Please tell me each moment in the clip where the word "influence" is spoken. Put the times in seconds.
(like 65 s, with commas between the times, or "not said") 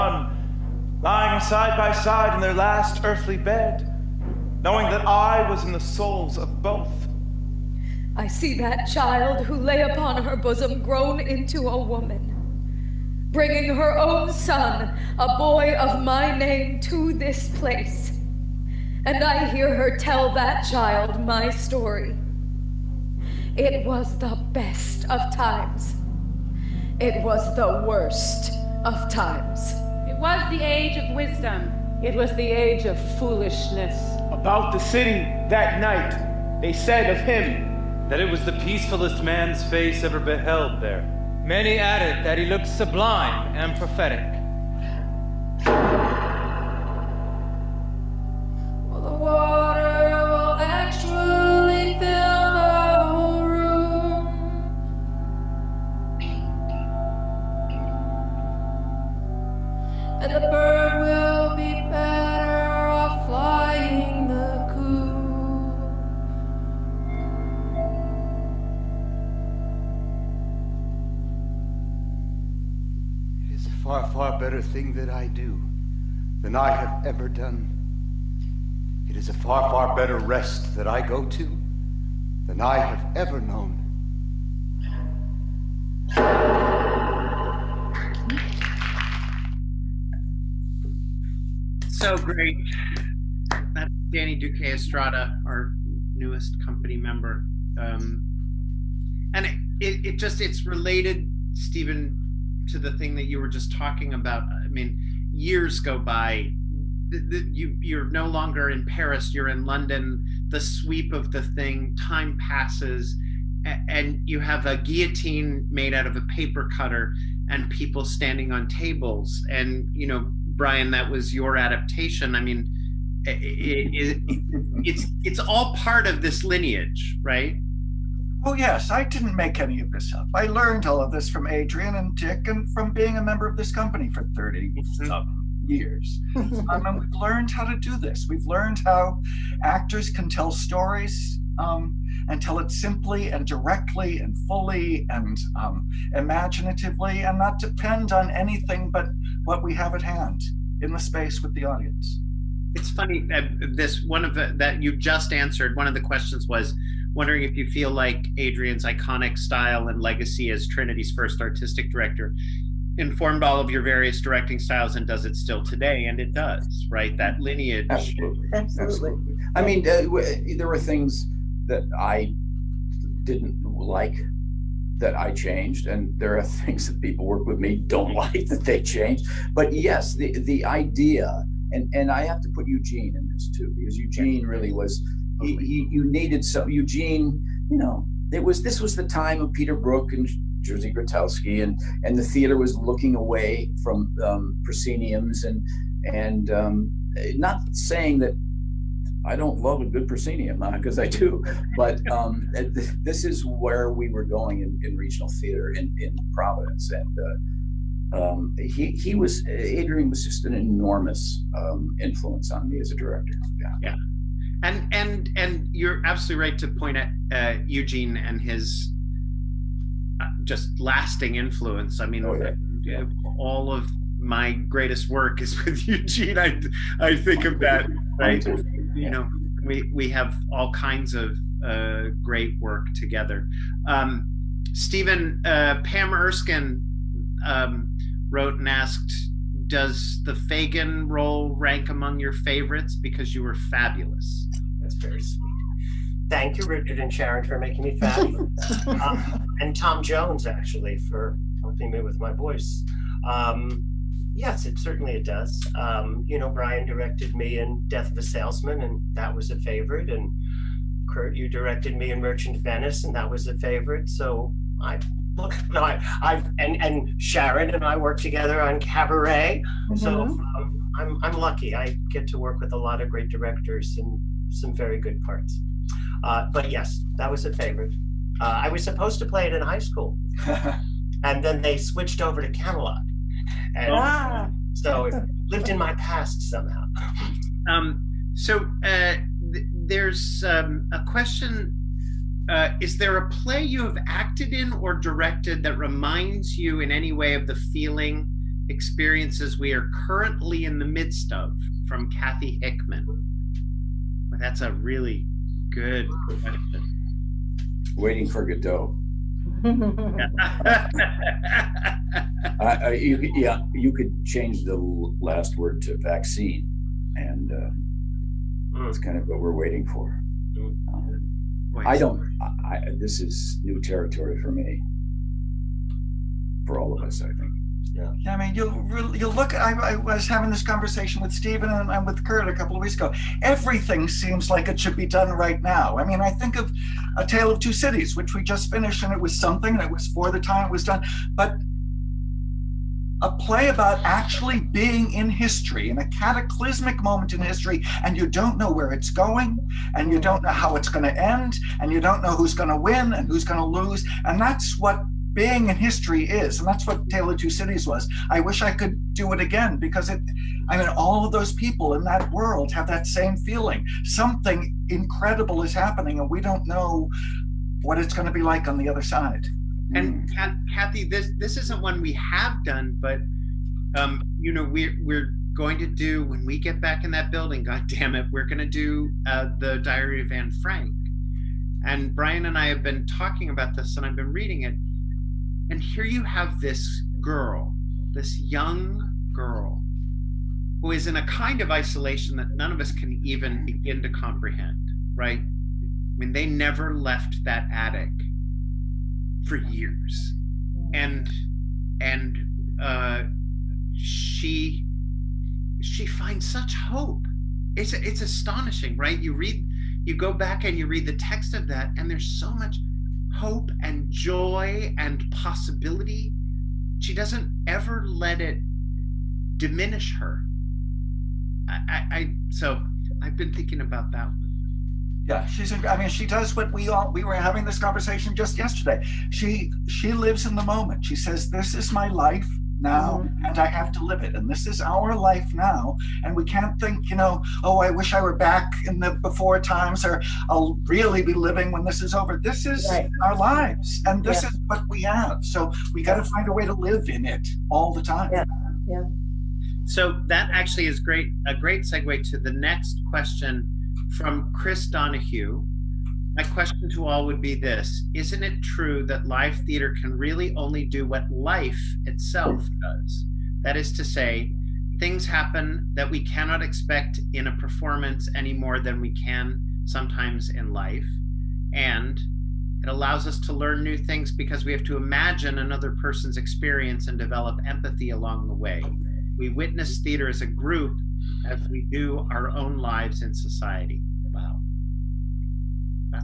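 211 s, 221 s.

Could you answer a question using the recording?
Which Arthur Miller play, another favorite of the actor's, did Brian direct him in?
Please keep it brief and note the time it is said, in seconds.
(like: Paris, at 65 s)
Death of a Salesman, at 257 s.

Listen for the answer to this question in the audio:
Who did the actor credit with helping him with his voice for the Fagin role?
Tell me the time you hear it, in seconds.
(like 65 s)
249 s.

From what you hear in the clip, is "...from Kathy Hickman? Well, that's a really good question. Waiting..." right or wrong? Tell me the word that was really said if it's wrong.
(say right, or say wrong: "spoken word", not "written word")
right.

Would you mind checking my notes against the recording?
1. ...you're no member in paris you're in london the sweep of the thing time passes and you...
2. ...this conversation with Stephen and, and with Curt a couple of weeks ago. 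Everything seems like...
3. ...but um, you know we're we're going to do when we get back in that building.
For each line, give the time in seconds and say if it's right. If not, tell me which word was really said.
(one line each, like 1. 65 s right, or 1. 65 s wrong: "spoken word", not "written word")
1. 107 s wrong: "longer", not "member"
2. 330 s right
3. 373 s right.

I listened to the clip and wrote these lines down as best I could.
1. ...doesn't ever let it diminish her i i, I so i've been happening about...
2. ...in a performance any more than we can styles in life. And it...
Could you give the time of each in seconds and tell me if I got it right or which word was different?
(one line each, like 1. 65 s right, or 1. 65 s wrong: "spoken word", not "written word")
1. 417 s wrong: "thinking", not "happening"
2. 467 s wrong: "sometimes", not "styles".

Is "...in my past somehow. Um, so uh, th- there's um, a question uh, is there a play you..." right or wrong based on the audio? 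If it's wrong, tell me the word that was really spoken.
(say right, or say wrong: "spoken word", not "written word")
right.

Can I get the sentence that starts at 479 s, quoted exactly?
We witness theater as a group as we do our own lives in society.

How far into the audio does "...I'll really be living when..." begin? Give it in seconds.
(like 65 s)
440 s.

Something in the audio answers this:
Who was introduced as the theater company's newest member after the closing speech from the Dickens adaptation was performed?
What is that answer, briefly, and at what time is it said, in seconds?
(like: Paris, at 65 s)
Danny Duque Estrada, at 94 s.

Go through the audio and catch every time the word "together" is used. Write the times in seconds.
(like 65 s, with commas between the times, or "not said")
232 s, 268 s.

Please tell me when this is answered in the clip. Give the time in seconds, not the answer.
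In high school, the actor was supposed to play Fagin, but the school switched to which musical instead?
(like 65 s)
282 s.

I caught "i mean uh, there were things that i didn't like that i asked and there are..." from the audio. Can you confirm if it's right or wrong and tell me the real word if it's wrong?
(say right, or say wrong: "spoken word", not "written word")
wrong: "changed", not "asked".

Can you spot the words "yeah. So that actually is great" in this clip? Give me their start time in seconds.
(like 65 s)
448 s.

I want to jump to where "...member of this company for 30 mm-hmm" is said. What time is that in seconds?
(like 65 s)
133 s.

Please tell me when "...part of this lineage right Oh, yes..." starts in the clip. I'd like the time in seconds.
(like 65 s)
125 s.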